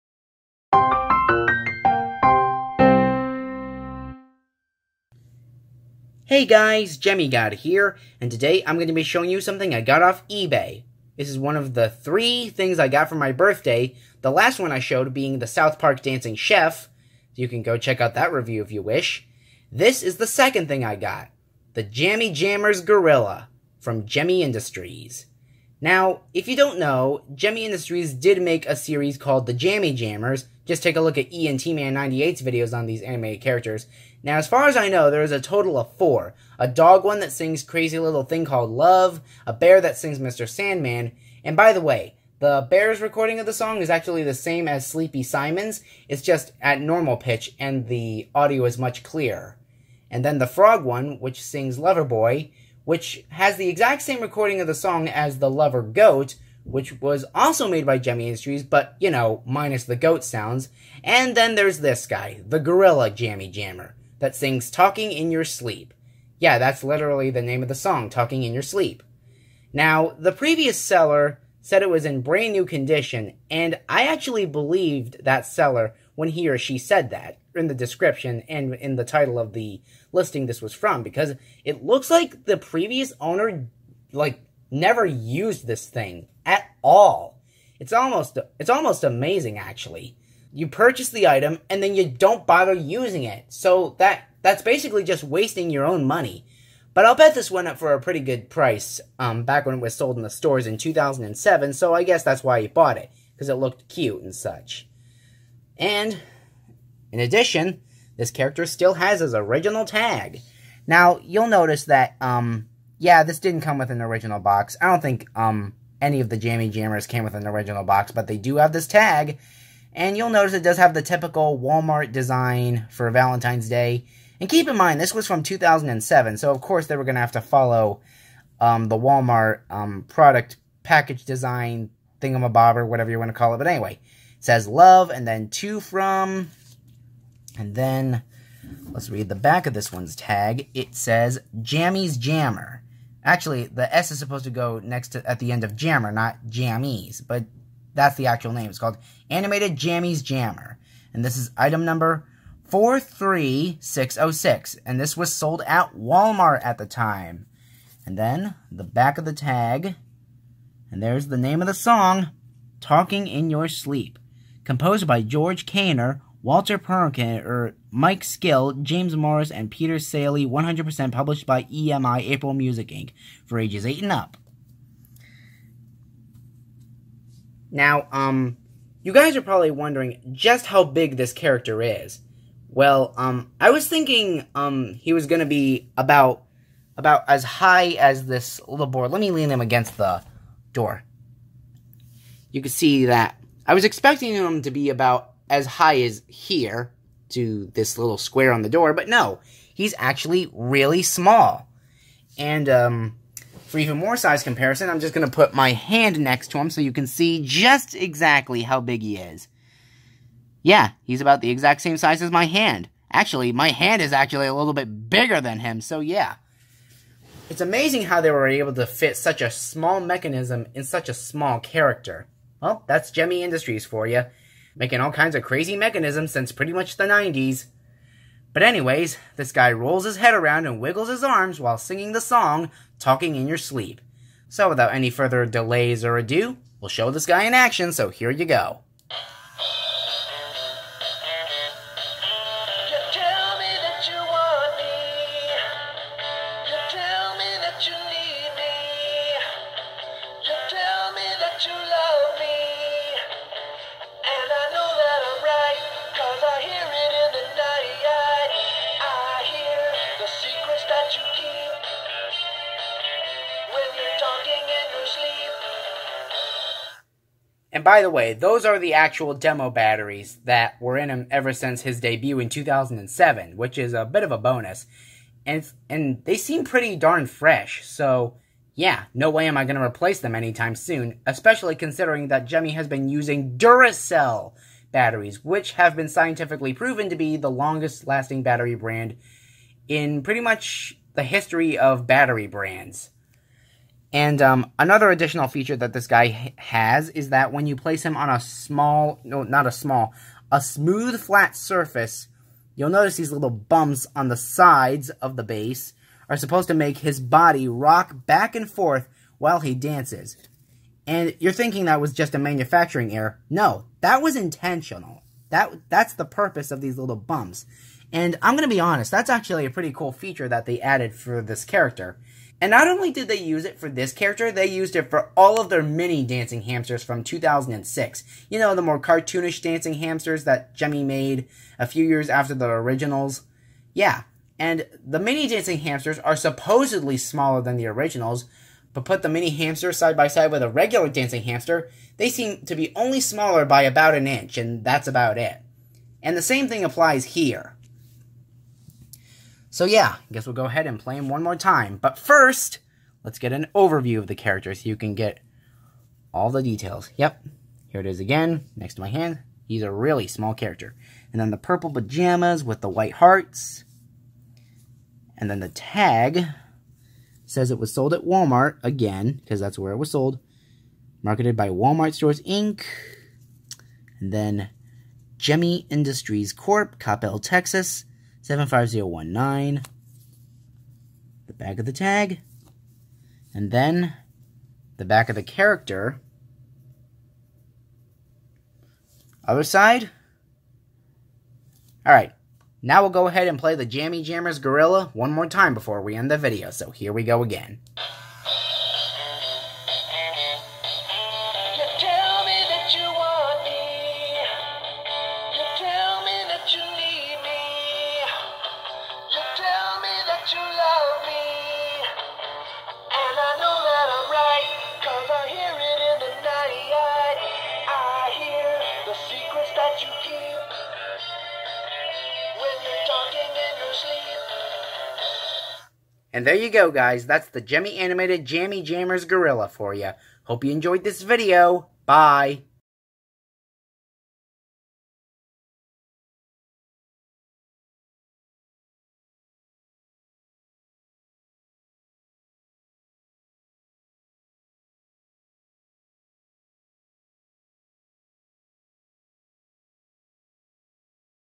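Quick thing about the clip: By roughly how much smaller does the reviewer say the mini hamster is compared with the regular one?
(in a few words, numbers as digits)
about an inch.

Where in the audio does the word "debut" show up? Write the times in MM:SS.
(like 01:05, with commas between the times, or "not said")
04:31.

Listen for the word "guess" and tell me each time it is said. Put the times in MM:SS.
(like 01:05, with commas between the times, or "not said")
01:42, 05:50.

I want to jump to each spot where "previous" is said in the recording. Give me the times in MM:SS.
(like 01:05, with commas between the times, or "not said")
01:10, 01:22.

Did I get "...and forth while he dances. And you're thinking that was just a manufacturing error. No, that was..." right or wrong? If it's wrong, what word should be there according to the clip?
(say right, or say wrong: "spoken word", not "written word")
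right.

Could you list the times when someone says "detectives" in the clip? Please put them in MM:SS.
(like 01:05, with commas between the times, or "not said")
not said.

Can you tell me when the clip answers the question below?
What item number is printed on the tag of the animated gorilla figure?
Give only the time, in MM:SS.
02:32.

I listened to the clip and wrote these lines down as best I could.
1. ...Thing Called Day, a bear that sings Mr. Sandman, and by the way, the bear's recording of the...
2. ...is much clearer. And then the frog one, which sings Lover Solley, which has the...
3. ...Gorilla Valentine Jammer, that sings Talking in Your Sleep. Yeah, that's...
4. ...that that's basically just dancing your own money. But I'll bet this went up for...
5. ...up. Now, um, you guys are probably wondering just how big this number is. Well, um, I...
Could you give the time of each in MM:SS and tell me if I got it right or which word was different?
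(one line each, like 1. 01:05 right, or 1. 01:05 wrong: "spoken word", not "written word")
1. 00:38 wrong: "Love", not "Day"
2. 00:48 wrong: "Boy", not "Solley"
3. 01:02 wrong: "Jammie", not "Valentine"
4. 01:33 wrong: "wasting", not "dancing"
5. 02:54 wrong: "character", not "number".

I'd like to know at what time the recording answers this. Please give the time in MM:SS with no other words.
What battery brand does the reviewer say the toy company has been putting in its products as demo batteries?
04:43.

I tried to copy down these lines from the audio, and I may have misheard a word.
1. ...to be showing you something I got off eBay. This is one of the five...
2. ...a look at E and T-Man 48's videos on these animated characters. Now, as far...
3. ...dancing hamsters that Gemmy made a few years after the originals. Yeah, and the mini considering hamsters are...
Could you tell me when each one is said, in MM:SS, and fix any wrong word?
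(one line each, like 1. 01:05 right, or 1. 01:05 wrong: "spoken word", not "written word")
1. 00:08 wrong: "three", not "five"
2. 00:30 wrong: "98", not "48"
3. 05:29 wrong: "dancing", not "considering".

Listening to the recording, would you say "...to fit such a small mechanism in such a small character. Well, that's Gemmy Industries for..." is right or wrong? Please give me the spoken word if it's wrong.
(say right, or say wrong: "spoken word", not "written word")
right.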